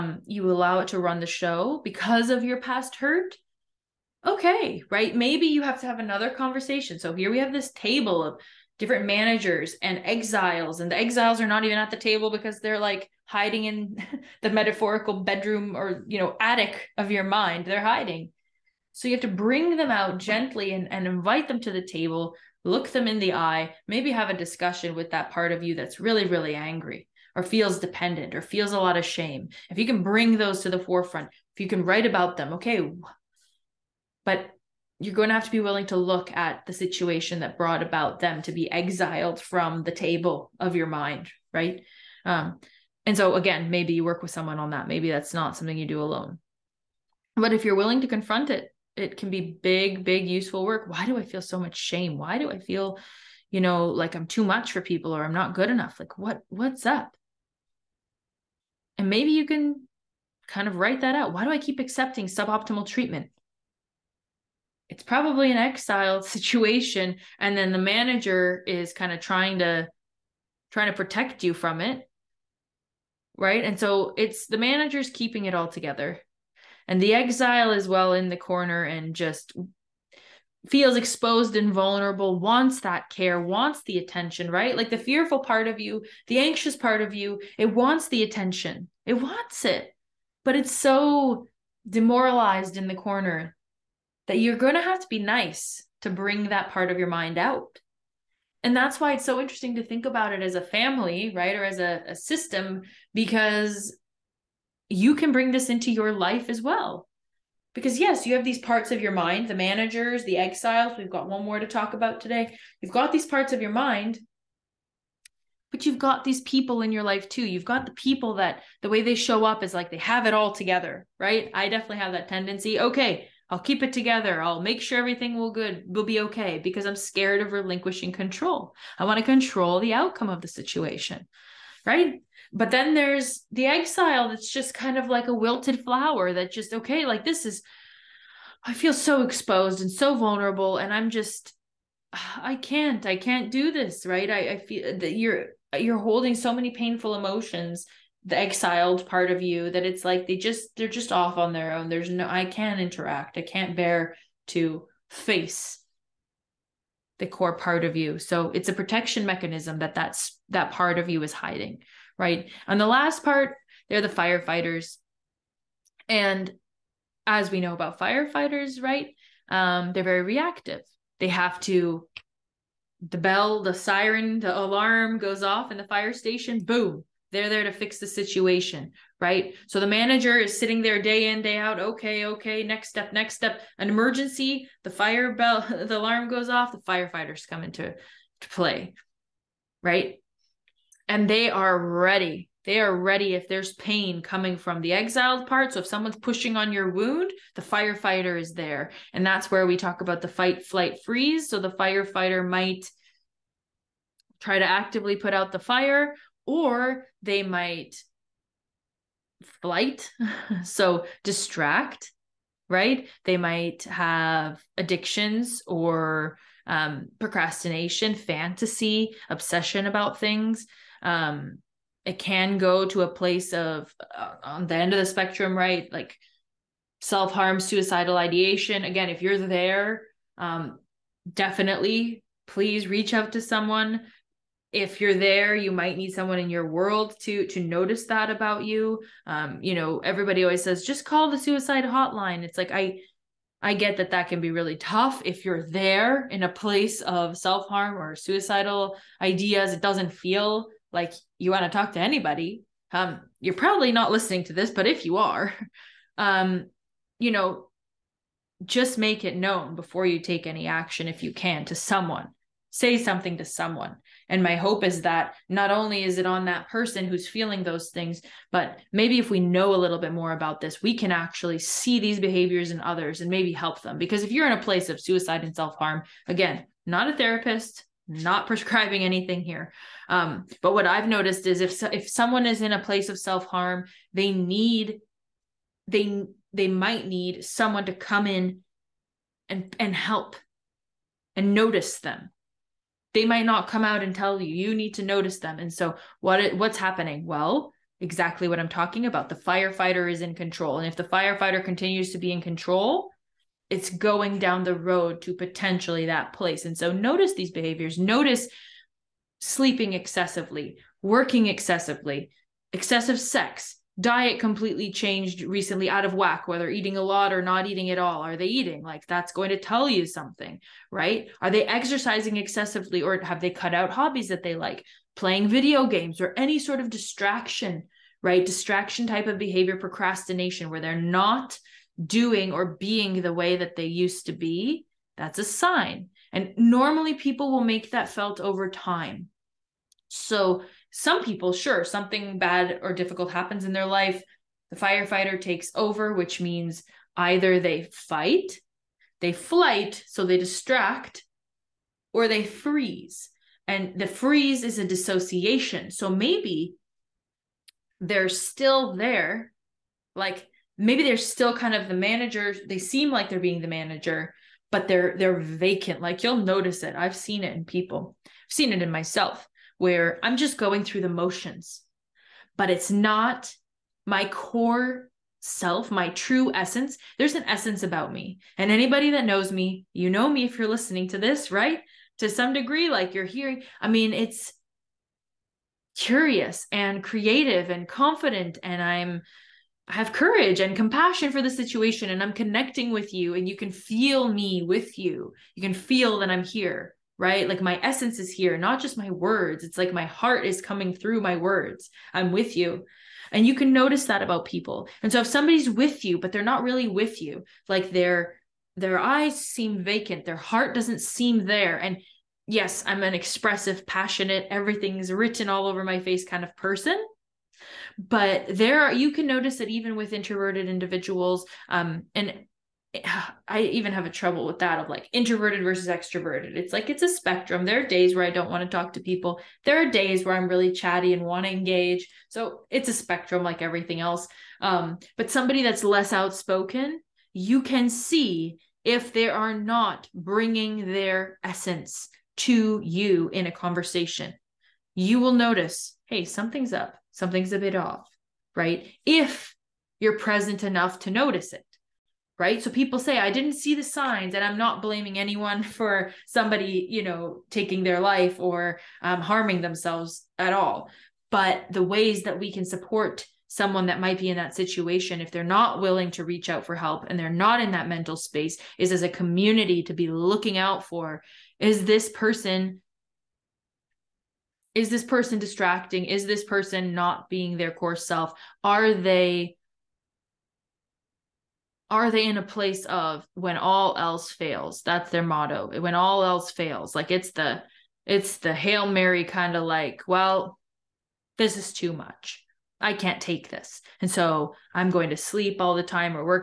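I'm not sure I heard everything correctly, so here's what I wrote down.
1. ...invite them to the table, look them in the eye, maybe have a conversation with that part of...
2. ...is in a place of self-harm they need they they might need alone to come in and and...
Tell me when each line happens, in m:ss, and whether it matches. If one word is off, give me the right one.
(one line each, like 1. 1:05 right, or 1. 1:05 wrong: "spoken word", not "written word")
1. 0:21 wrong: "discussion", not "conversation"
2. 4:42 wrong: "someone", not "alone".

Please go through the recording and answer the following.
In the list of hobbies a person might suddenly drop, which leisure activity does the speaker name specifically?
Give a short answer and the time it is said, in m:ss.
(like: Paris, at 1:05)
video games, at 5:25.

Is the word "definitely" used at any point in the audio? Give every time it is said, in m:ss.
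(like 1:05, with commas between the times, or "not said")
2:01, 3:51.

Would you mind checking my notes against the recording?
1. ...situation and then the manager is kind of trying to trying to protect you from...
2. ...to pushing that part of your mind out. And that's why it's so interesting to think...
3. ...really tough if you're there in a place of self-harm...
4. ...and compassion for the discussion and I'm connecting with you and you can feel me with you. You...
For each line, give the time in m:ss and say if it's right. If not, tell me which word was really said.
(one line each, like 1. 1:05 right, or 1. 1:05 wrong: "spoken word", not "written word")
1. 1:06 right
2. 1:36 wrong: "bring", not "pushing"
3. 4:04 right
4. 6:30 wrong: "situation", not "discussion".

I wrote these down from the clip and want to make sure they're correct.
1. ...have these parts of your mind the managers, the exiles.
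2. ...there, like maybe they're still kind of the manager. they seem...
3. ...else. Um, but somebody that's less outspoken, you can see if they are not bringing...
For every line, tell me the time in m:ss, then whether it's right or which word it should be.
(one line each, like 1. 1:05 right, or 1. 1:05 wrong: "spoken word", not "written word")
1. 1:48 right
2. 5:58 right
3. 7:13 right.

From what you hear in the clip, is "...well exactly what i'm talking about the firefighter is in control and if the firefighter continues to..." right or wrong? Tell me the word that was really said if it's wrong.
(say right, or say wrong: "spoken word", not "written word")
right.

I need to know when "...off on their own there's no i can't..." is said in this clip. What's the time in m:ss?
2:31.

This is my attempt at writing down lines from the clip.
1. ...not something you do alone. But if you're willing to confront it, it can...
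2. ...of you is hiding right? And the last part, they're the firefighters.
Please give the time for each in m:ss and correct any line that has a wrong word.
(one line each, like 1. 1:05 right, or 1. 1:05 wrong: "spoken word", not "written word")
1. 0:45 right
2. 2:40 right.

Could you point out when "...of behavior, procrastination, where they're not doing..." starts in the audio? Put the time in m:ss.
5:29.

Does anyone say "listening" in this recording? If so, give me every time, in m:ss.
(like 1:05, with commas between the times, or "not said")
4:14, 6:20.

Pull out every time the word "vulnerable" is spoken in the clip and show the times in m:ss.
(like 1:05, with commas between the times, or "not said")
1:21, 2:20.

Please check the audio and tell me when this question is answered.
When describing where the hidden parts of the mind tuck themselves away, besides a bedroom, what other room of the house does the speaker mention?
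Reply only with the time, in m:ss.
0:16.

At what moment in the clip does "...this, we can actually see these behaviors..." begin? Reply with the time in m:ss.
4:30.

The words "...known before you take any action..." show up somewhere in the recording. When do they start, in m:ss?
4:19.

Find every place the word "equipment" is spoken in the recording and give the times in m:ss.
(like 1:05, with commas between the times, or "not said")
not said.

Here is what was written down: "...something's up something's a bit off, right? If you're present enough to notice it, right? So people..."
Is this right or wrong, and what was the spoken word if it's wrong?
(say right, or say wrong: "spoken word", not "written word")
right.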